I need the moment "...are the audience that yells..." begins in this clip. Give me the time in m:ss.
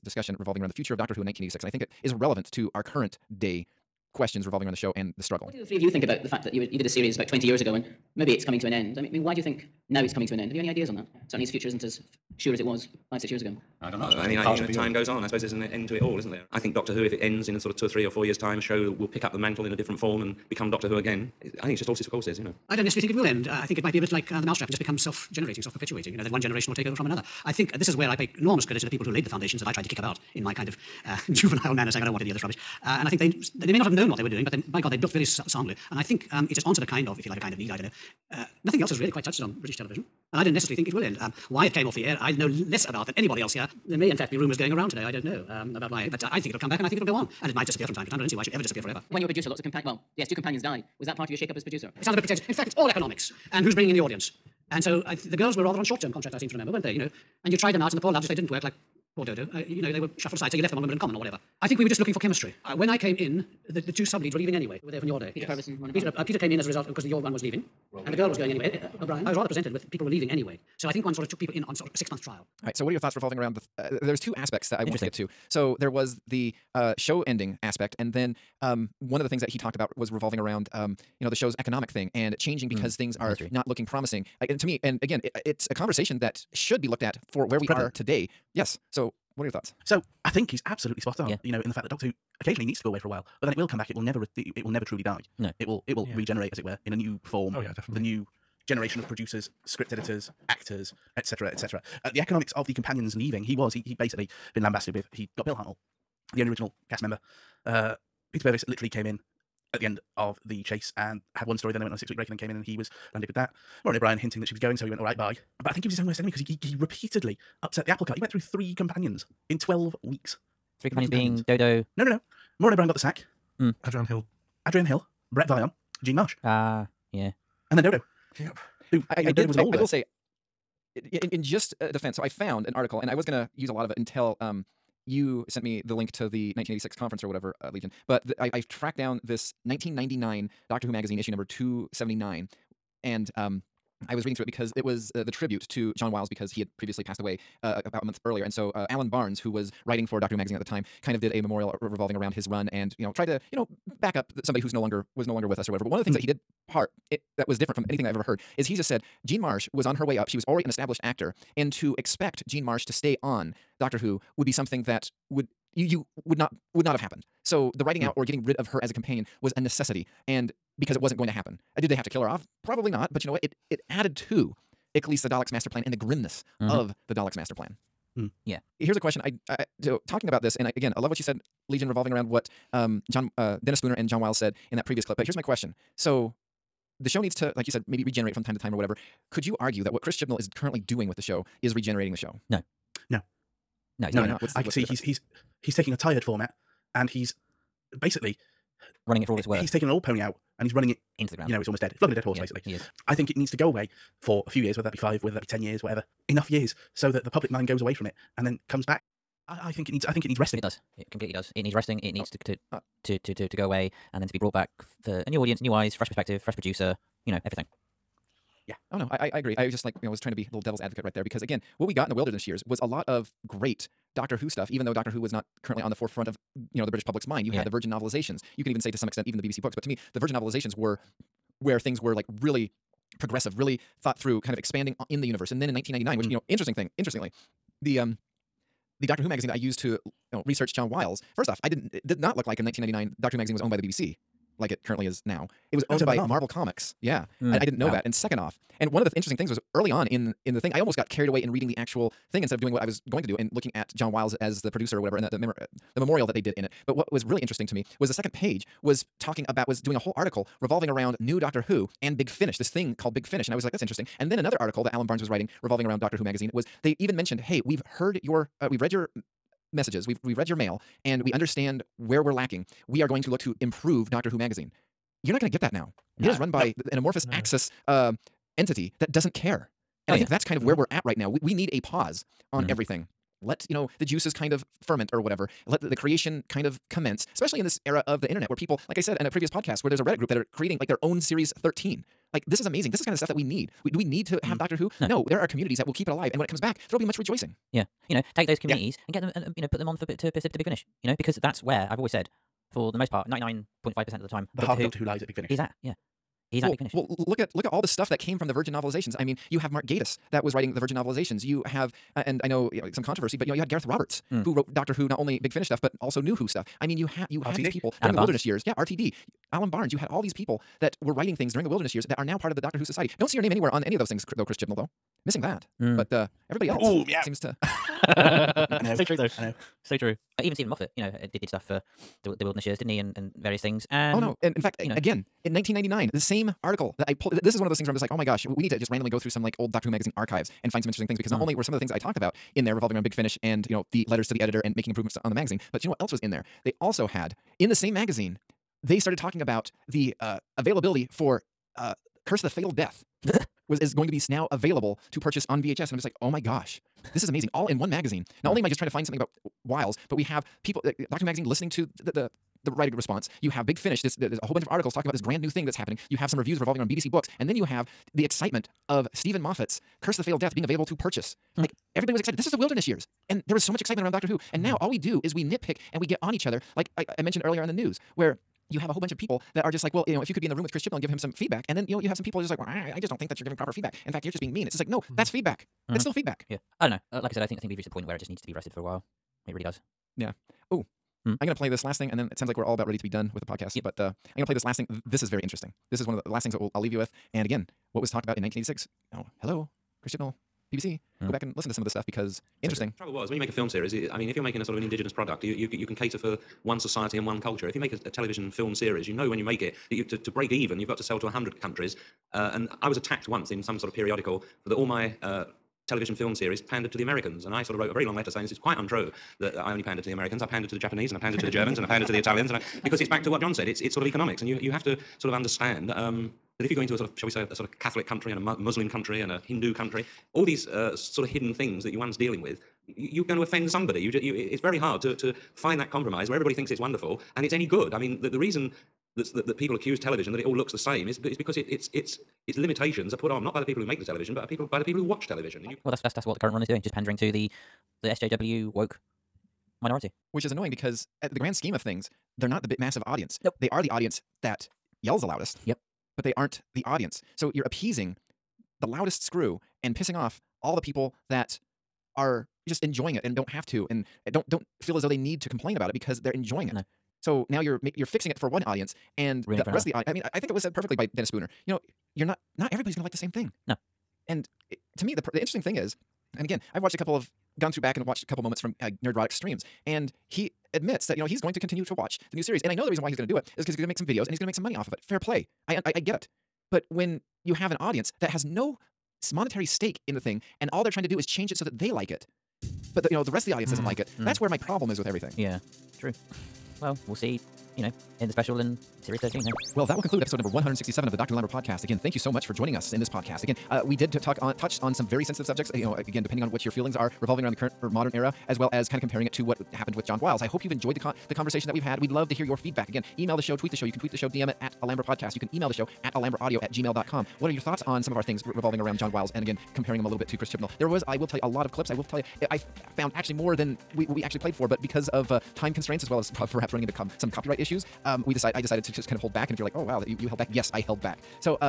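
7:33.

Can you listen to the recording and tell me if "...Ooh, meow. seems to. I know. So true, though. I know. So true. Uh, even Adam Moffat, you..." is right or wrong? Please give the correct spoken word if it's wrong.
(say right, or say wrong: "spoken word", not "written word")
wrong: "Steven", not "Adam".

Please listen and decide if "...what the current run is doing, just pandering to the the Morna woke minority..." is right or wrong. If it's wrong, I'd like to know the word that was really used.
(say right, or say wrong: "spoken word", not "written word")
wrong: "SJW", not "Morna".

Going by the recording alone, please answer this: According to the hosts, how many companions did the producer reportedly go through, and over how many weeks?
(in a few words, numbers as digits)
3 companions in 12 weeks.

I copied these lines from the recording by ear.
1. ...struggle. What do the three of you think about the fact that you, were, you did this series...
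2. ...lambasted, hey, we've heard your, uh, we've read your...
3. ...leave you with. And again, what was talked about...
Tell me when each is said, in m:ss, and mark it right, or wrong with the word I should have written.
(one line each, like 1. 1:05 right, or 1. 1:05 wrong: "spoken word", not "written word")
1. 0:05 right
2. 4:27 wrong: "mentioned", not "lambasted"
3. 6:36 right.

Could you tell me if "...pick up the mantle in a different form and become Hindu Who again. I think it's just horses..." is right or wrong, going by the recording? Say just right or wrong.
wrong.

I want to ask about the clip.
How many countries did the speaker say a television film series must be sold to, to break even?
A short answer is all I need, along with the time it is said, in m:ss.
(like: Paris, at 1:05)
100, at 6:51.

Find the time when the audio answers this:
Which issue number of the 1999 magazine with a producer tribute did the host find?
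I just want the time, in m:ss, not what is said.
2:21.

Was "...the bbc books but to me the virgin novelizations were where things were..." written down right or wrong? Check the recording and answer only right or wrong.
right.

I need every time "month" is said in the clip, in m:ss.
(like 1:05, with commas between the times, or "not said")
1:11, 2:28.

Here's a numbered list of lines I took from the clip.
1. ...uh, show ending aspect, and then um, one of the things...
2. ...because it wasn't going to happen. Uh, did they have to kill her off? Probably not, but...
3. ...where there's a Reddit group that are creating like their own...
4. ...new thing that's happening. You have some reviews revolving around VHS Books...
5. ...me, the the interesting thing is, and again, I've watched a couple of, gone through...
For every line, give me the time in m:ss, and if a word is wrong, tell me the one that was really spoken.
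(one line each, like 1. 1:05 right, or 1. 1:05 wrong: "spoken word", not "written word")
1. 1:16 right
2. 2:50 right
3. 4:49 right
4. 6:05 wrong: "BBC", not "VHS"
5. 7:55 right.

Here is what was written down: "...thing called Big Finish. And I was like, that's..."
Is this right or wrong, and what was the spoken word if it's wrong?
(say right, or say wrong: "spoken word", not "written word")
right.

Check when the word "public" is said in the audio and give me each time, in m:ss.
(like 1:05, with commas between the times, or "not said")
3:27, 3:47.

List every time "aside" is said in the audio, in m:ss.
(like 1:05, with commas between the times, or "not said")
1:00.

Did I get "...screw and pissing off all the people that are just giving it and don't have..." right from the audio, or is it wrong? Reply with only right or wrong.
wrong.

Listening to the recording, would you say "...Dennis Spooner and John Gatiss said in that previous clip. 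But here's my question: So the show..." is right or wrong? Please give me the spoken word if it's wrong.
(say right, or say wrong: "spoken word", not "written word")
wrong: "Wiles", not "Gatiss".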